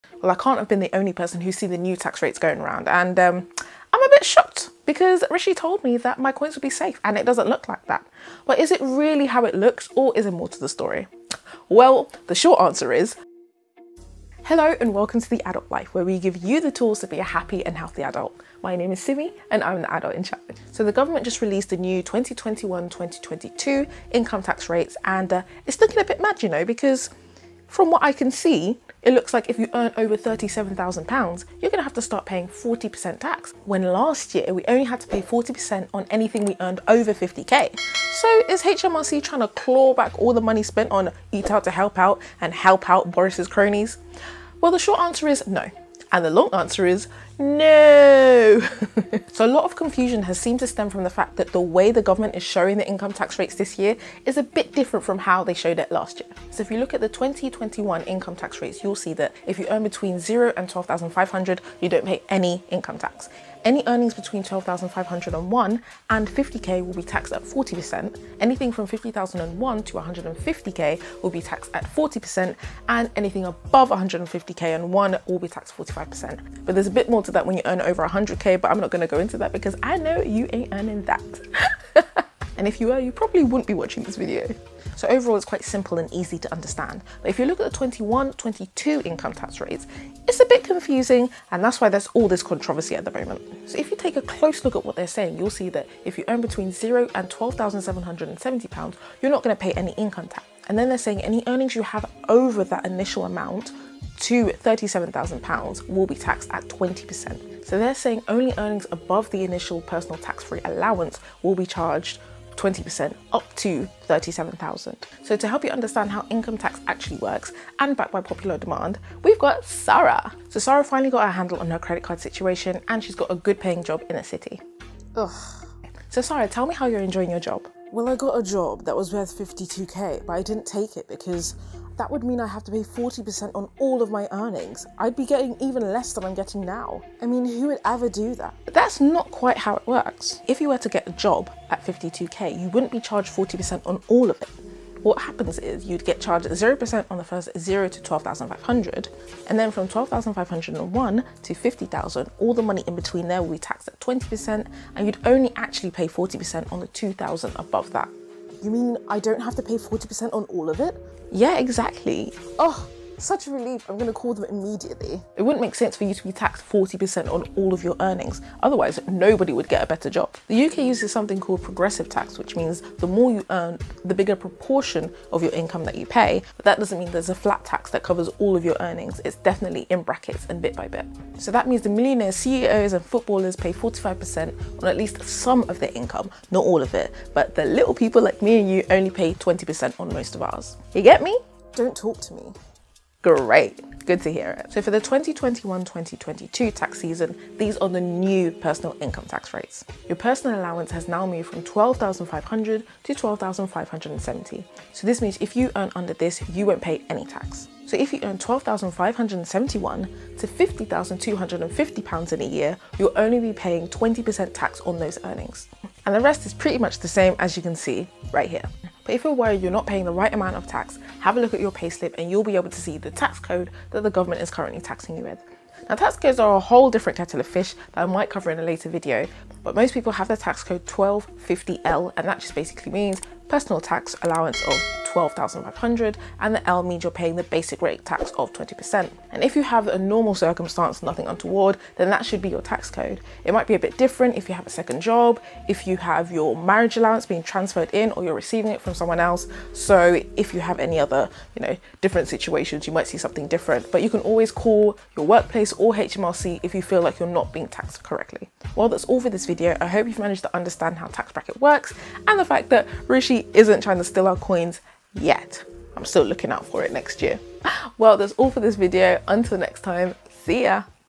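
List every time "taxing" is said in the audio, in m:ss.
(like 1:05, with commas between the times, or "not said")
3:44.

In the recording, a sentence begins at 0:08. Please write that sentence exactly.
But is it really how it looks or is it more to the story?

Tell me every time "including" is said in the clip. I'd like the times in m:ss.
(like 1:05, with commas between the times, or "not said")
not said.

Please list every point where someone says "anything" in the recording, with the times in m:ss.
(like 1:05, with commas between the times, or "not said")
0:36, 1:08, 1:13.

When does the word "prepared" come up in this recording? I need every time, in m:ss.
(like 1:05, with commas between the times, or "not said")
not said.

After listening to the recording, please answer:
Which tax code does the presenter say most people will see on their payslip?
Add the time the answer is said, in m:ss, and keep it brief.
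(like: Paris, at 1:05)
1250L, at 3:50.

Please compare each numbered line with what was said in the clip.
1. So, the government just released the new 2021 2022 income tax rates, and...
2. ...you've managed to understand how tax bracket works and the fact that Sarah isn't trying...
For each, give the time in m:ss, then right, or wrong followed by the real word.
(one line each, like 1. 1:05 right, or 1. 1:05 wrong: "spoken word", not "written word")
1. 0:20 right
2. 4:20 wrong: "Rishi", not "Sarah".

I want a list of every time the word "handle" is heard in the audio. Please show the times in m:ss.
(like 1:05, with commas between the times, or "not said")
2:01.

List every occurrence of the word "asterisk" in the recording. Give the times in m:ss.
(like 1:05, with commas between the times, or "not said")
not said.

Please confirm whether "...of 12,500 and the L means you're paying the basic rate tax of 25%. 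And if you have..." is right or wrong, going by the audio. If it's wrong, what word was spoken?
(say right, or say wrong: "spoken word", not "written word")
wrong: "20", not "25".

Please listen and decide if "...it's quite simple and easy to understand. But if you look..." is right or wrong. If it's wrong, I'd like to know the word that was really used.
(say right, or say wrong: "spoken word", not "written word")
right.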